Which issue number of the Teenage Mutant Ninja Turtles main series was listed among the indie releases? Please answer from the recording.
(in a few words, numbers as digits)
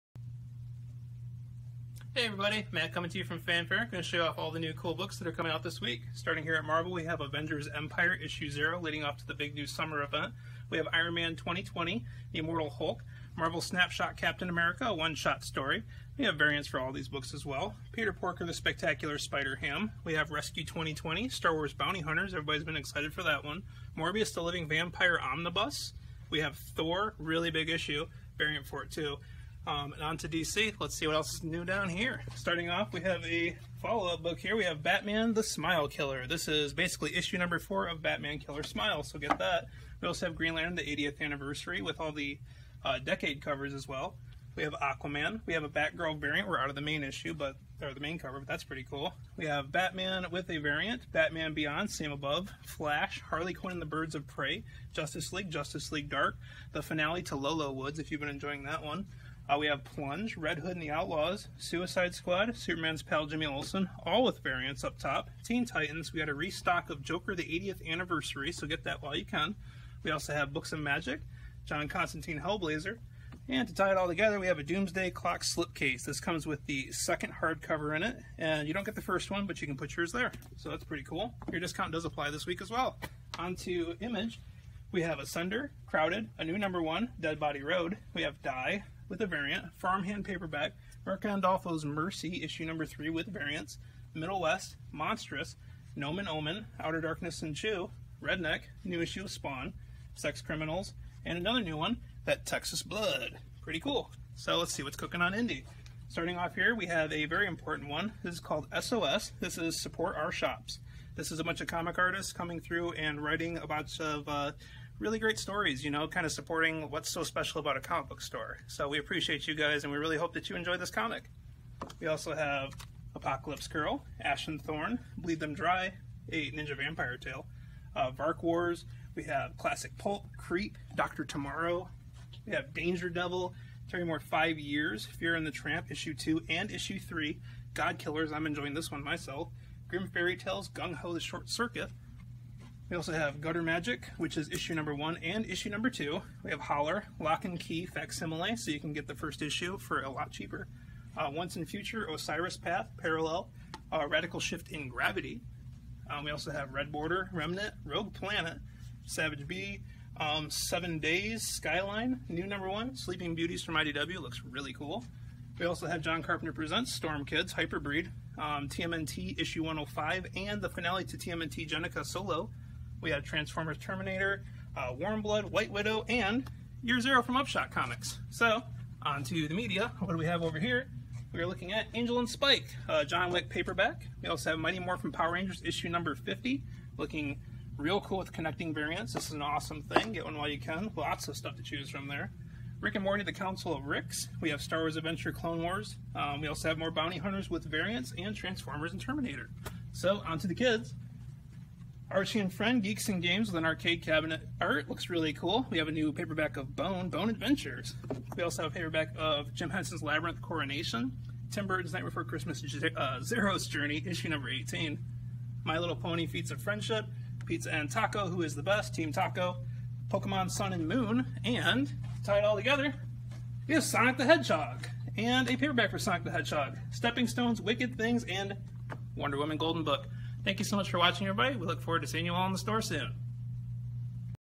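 105.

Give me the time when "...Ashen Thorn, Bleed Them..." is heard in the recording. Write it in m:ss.
2:04.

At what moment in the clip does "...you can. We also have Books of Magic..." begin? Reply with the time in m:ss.
1:09.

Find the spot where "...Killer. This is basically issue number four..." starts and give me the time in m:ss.
0:35.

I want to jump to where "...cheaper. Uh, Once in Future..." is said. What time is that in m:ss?
2:30.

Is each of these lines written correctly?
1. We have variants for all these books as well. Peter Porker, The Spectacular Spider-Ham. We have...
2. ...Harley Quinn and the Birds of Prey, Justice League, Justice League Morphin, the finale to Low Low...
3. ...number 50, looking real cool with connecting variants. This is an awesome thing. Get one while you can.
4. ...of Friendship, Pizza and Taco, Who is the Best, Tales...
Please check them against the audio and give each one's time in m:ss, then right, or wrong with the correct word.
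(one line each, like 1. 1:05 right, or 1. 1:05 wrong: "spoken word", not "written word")
1. 0:16 right
2. 0:53 wrong: "Dark", not "Morphin"
3. 3:05 right
4. 3:36 wrong: "Team", not "Tales".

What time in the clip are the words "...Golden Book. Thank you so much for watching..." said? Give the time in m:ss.
3:49.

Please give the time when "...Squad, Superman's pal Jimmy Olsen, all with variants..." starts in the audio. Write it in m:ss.
1:02.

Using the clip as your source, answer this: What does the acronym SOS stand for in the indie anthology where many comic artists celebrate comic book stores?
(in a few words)
Support Our Shops.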